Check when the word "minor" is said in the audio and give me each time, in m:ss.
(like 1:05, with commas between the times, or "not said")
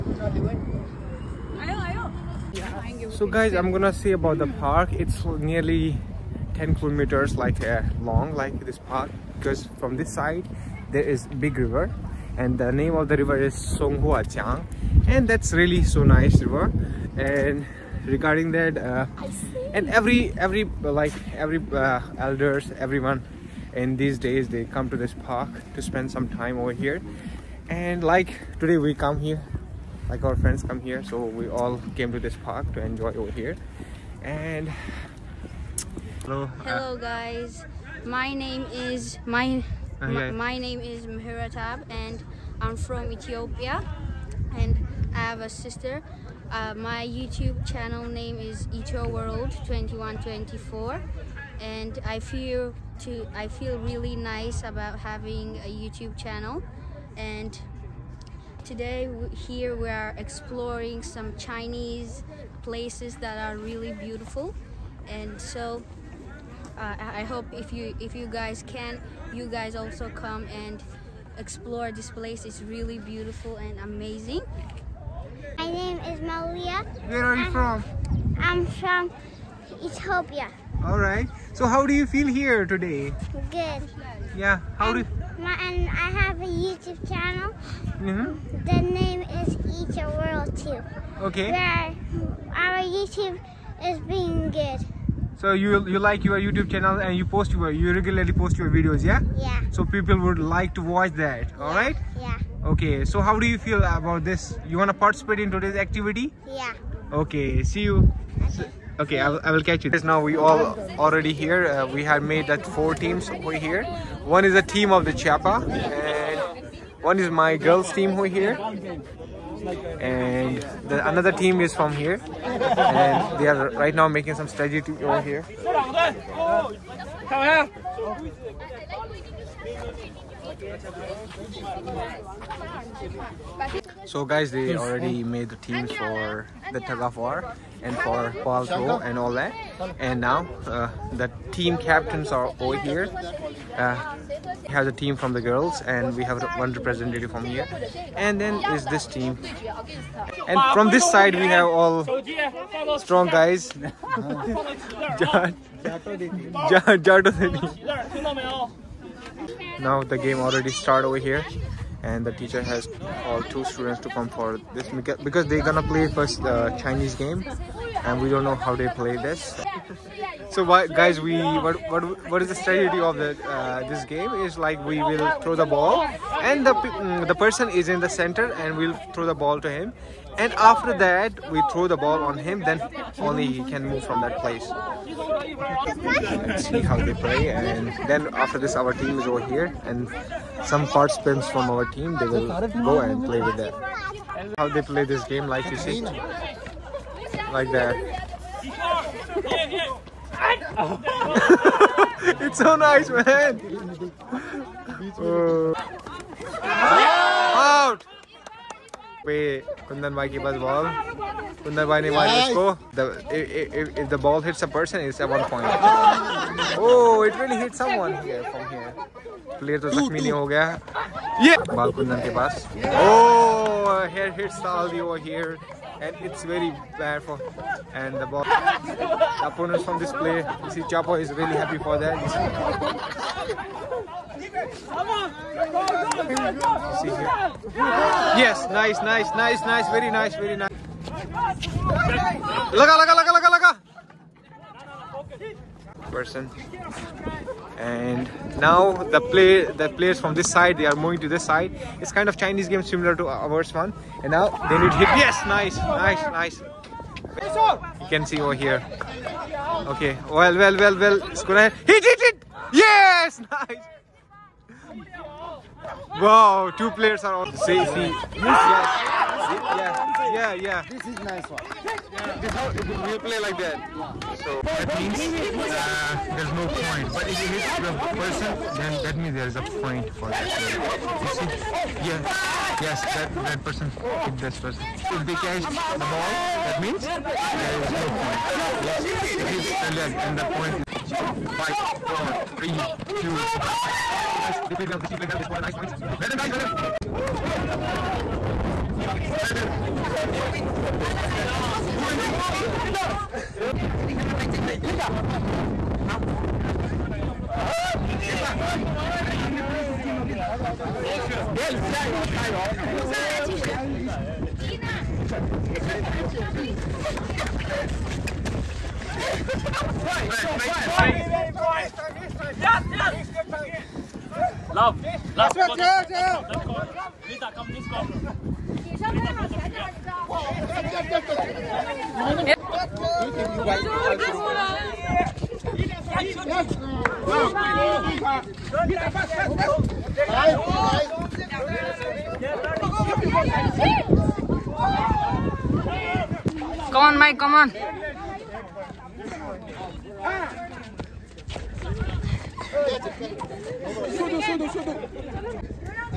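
not said.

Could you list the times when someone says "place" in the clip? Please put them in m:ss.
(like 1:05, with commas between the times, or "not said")
1:02, 1:12, 3:04.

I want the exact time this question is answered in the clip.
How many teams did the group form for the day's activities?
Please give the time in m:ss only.
1:52.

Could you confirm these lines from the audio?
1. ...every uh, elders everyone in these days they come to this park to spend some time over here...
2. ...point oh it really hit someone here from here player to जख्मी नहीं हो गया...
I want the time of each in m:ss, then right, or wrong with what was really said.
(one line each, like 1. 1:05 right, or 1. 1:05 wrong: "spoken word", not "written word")
1. 0:21 right
2. 3:35 right.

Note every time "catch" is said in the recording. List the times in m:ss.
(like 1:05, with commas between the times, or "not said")
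1:49, 4:45.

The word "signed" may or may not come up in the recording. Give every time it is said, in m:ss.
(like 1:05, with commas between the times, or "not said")
not said.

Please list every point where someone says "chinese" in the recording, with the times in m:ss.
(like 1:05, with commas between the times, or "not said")
1:01, 2:46, 4:12.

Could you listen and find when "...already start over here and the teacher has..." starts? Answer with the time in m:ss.
2:40.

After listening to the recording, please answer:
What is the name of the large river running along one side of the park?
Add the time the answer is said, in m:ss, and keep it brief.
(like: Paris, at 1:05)
Songhua Jiang, at 0:13.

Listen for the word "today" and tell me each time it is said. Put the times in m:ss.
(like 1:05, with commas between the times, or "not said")
0:28, 0:58, 1:22, 1:45.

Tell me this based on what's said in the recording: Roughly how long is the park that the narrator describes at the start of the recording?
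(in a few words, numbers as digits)
10 kilometers.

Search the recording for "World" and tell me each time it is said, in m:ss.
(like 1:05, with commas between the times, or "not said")
0:49, 1:30.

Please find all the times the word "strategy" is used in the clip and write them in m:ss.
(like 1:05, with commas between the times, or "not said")
2:04, 2:52.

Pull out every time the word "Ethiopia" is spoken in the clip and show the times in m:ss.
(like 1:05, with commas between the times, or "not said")
0:43, 1:19.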